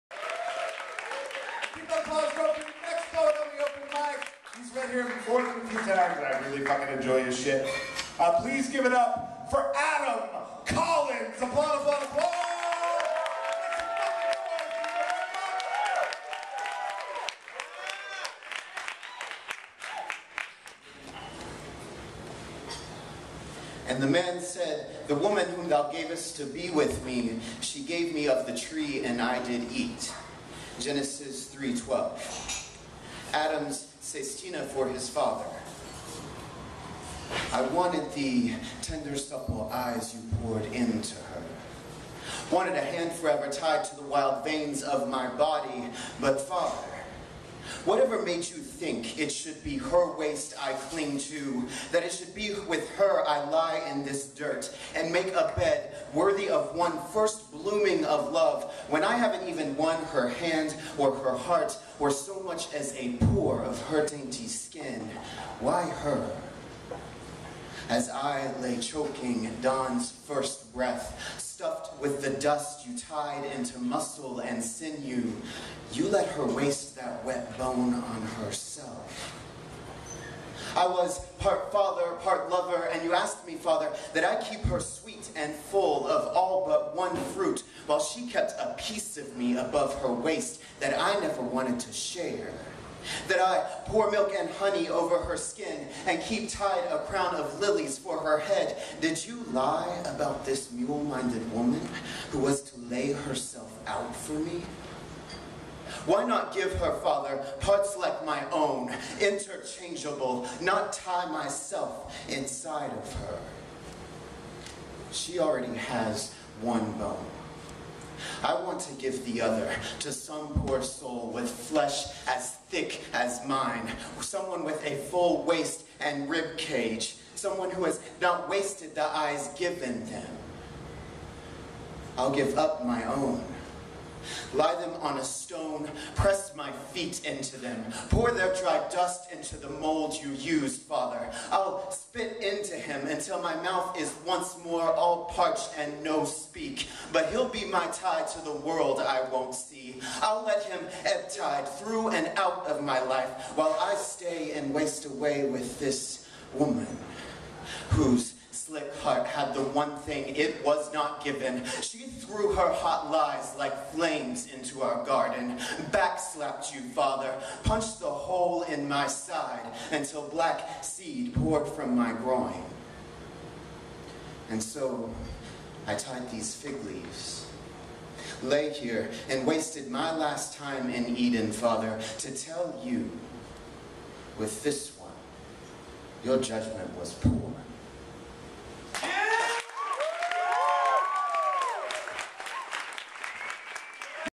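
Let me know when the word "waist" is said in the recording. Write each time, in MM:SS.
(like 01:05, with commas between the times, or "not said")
00:50, 01:30, 02:05.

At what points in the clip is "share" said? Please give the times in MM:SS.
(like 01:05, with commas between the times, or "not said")
01:31.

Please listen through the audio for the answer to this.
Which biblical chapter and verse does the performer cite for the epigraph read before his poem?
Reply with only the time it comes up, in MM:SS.
00:30.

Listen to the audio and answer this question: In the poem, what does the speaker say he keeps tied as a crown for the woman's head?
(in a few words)
lilies.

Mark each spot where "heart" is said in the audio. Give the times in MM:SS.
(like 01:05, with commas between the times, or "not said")
01:01, 02:39.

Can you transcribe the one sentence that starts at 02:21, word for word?
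I'll spit into him until my mouth is once more all parched and no speak.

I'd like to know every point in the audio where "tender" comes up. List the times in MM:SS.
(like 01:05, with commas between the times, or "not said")
00:38.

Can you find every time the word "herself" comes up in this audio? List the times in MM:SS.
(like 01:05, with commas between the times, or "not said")
01:18, 01:43.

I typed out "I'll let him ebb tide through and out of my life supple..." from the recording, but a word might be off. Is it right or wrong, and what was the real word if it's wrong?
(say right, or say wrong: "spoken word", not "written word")
wrong: "while", not "supple".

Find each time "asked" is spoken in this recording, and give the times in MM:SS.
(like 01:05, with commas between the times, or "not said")
01:23.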